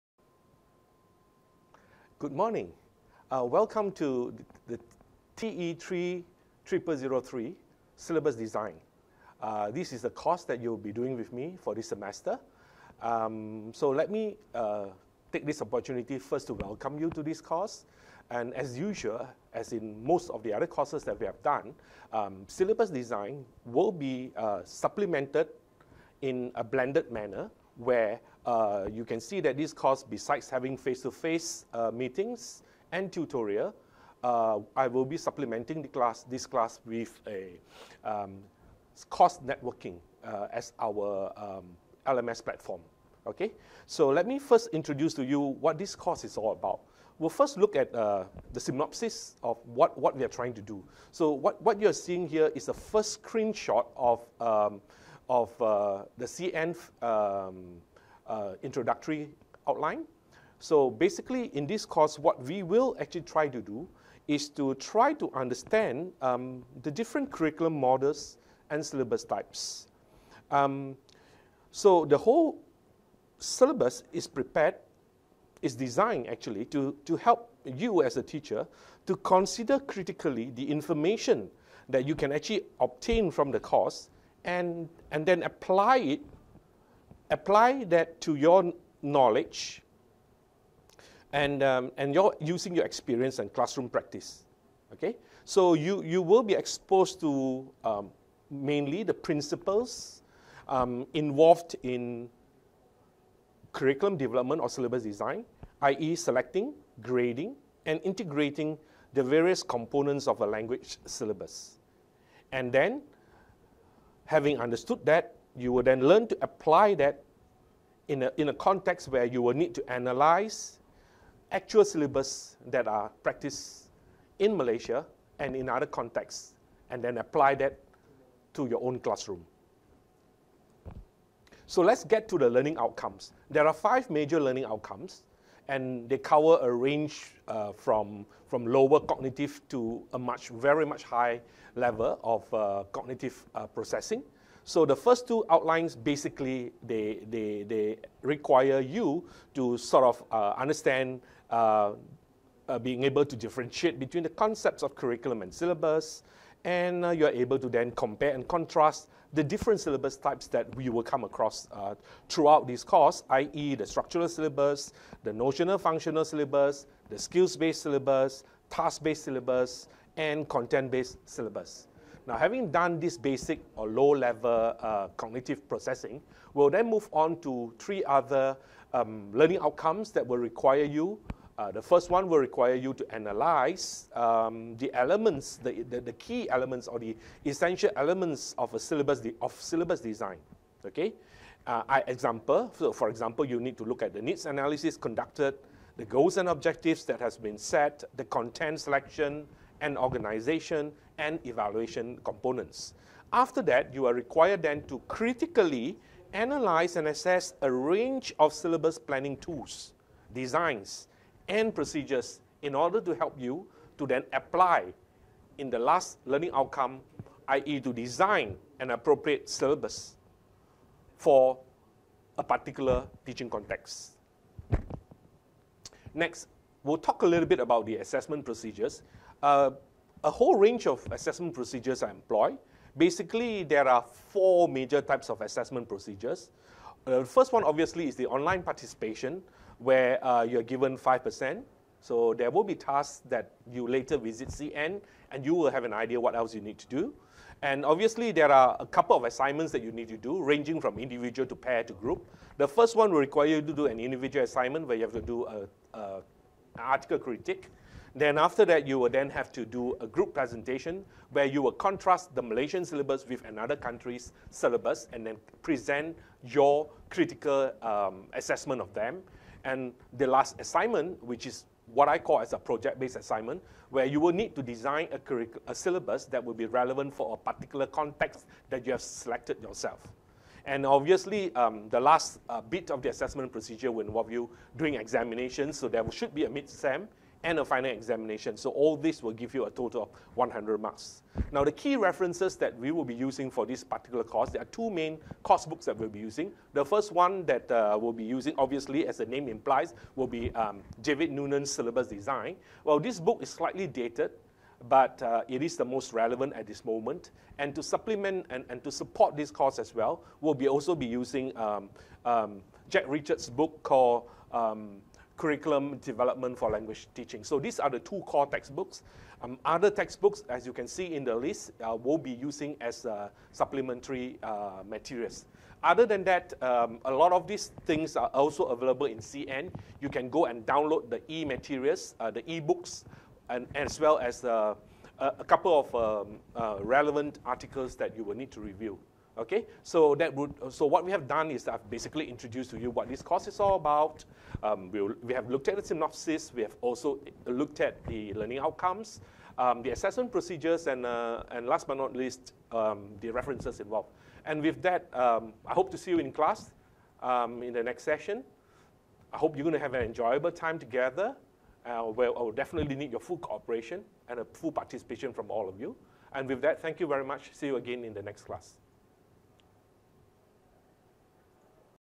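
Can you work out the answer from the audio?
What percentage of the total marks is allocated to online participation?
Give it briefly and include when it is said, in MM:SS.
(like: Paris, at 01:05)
5%, at 04:00.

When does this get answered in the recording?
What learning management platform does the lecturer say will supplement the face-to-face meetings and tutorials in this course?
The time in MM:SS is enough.
00:39.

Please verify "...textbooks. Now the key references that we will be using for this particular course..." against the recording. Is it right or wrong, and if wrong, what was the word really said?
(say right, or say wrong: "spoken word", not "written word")
wrong: "marks", not "textbooks".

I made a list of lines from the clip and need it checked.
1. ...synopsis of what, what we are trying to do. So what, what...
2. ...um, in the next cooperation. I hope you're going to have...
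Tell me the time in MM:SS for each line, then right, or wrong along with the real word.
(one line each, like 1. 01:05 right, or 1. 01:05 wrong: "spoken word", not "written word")
1. 00:48 right
2. 05:57 wrong: "session", not "cooperation".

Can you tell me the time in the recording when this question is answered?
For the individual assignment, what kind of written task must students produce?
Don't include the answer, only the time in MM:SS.
04:16.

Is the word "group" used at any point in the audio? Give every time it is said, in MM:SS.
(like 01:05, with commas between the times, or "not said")
04:11, 04:20.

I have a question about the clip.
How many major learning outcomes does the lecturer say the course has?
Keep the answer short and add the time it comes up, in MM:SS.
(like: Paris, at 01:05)
5, at 02:13.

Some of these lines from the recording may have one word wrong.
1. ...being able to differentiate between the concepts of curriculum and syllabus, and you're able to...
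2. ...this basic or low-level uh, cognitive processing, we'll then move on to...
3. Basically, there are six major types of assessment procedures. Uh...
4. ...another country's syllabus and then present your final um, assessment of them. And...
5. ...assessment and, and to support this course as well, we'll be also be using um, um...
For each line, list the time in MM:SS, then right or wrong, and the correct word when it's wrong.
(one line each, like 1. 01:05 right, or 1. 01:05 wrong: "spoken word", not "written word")
1. 02:32 right
2. 02:52 right
3. 03:52 wrong: "four", not "six"
4. 04:23 wrong: "critical", not "final"
5. 05:07 wrong: "supplement", not "assessment".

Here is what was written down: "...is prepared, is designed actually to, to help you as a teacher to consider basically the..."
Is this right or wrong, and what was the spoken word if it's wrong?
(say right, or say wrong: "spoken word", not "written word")
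wrong: "critically", not "basically".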